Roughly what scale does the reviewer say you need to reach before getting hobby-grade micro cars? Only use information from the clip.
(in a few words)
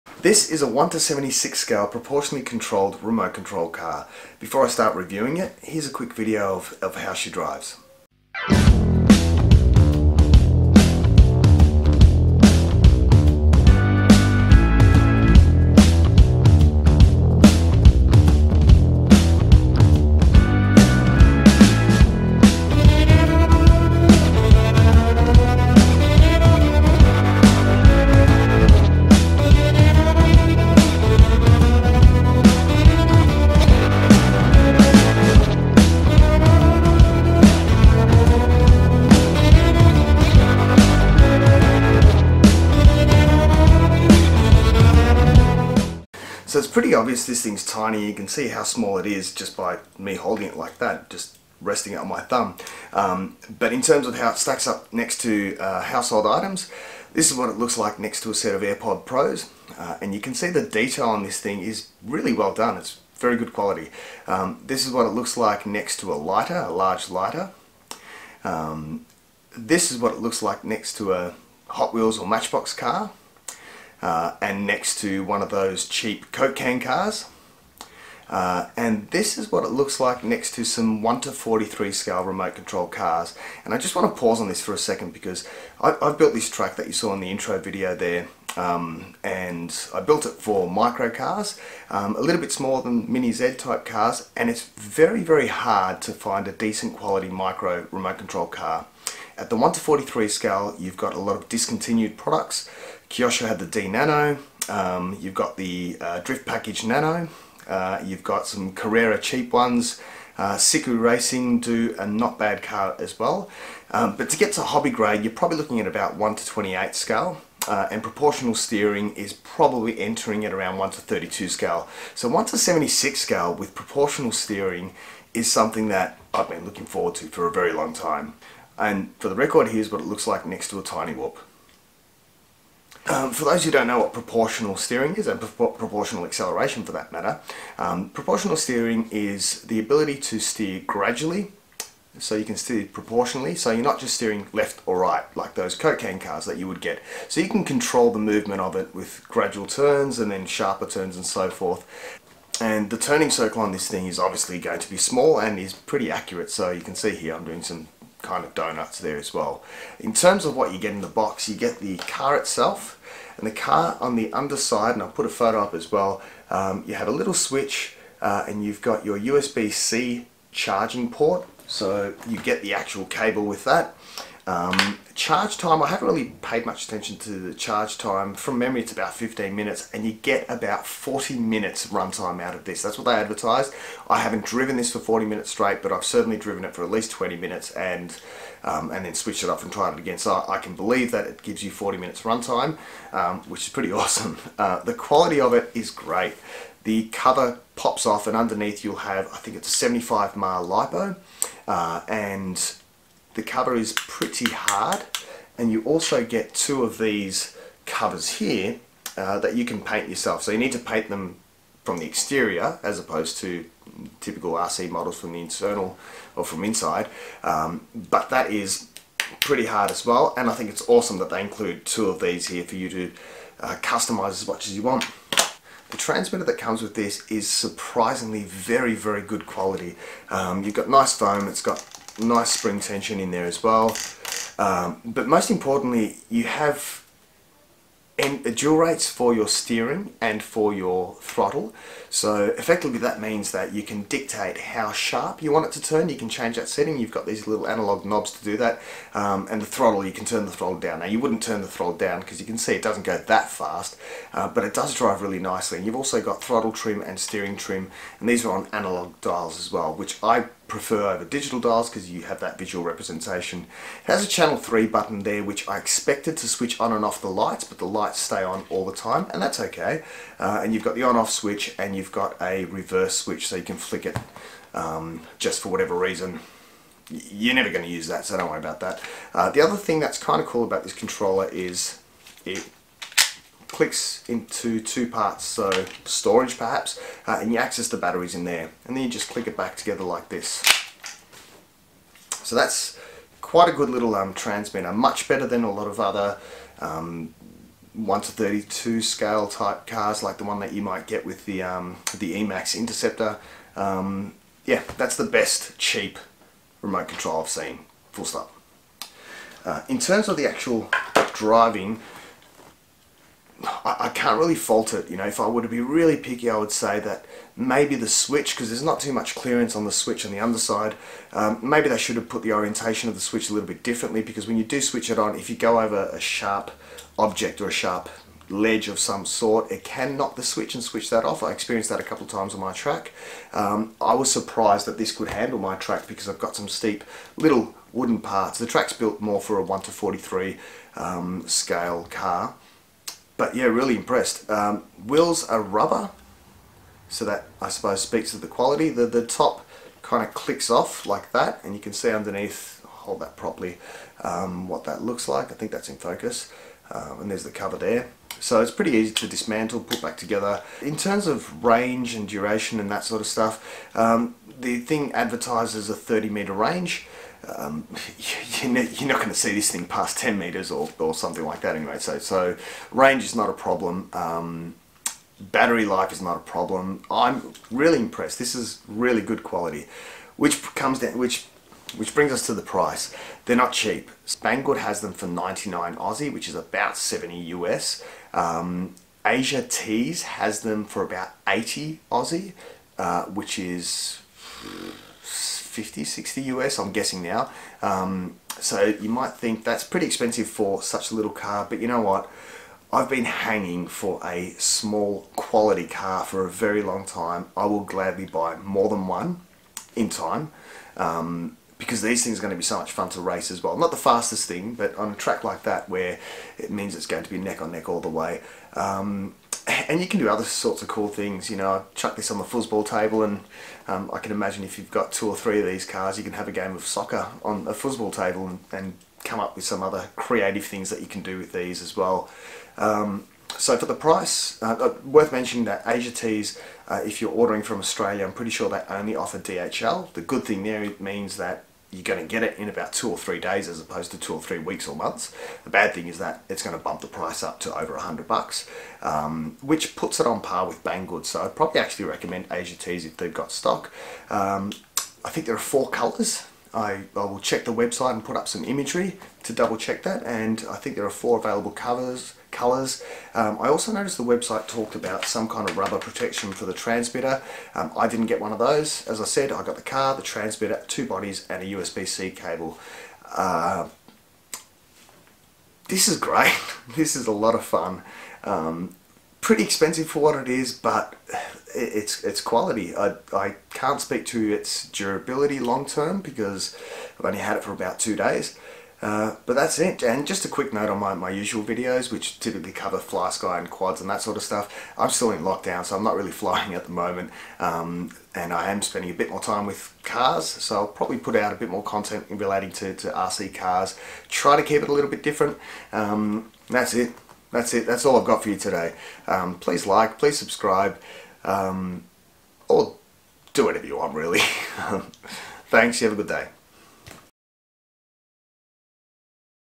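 1 to 28.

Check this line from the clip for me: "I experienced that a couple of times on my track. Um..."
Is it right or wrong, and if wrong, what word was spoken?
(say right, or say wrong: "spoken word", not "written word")
right.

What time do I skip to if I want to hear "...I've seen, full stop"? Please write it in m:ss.
5:07.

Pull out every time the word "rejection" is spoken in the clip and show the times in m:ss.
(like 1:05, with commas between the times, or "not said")
not said.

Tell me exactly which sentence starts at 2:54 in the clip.
Um, charge time, I haven't really paid much attention to the charge time.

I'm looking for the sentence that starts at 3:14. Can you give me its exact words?
Uh, the quality of it is great.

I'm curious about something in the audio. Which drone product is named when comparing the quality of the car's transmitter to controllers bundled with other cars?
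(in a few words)
Emax Interceptor.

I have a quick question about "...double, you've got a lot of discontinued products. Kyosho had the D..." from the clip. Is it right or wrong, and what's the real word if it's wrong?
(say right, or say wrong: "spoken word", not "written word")
wrong: "scale", not "double".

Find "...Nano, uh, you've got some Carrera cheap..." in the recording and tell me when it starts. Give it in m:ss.
1:46.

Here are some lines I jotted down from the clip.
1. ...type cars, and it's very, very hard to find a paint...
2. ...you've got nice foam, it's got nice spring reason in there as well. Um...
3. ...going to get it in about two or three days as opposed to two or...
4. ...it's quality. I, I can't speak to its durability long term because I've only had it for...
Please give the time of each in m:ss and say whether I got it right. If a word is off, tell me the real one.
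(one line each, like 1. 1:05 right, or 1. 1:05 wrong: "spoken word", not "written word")
1. 1:33 wrong: "decent", not "paint"
2. 3:50 wrong: "tension", not "reason"
3. 7:22 right
4. 8:02 right.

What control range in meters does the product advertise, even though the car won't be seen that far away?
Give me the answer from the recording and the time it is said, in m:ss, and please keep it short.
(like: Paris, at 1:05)
30 meters, at 6:05.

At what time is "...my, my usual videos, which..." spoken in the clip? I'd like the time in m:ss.
8:10.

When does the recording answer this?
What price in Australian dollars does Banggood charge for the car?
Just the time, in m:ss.
6:25.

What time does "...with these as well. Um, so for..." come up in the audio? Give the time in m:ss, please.
7:11.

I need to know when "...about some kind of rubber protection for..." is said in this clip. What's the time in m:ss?
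7:44.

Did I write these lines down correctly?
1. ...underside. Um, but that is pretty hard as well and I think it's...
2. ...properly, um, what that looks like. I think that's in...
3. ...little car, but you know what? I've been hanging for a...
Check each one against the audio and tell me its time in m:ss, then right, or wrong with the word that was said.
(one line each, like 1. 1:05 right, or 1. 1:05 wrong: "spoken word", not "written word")
1. 3:36 wrong: "inside", not "underside"
2. 5:53 right
3. 6:41 right.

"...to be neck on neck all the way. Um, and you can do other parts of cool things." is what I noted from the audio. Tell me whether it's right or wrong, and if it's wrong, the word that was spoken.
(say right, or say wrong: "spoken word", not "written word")
wrong: "sorts", not "parts".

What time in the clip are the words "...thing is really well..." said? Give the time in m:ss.
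1:01.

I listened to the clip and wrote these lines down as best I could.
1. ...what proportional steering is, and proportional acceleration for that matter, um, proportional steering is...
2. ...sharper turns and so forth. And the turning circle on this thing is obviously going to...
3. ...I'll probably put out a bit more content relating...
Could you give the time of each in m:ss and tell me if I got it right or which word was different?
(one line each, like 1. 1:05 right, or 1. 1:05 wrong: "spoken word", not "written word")
1. 2:13 right
2. 2:30 right
3. 8:20 right.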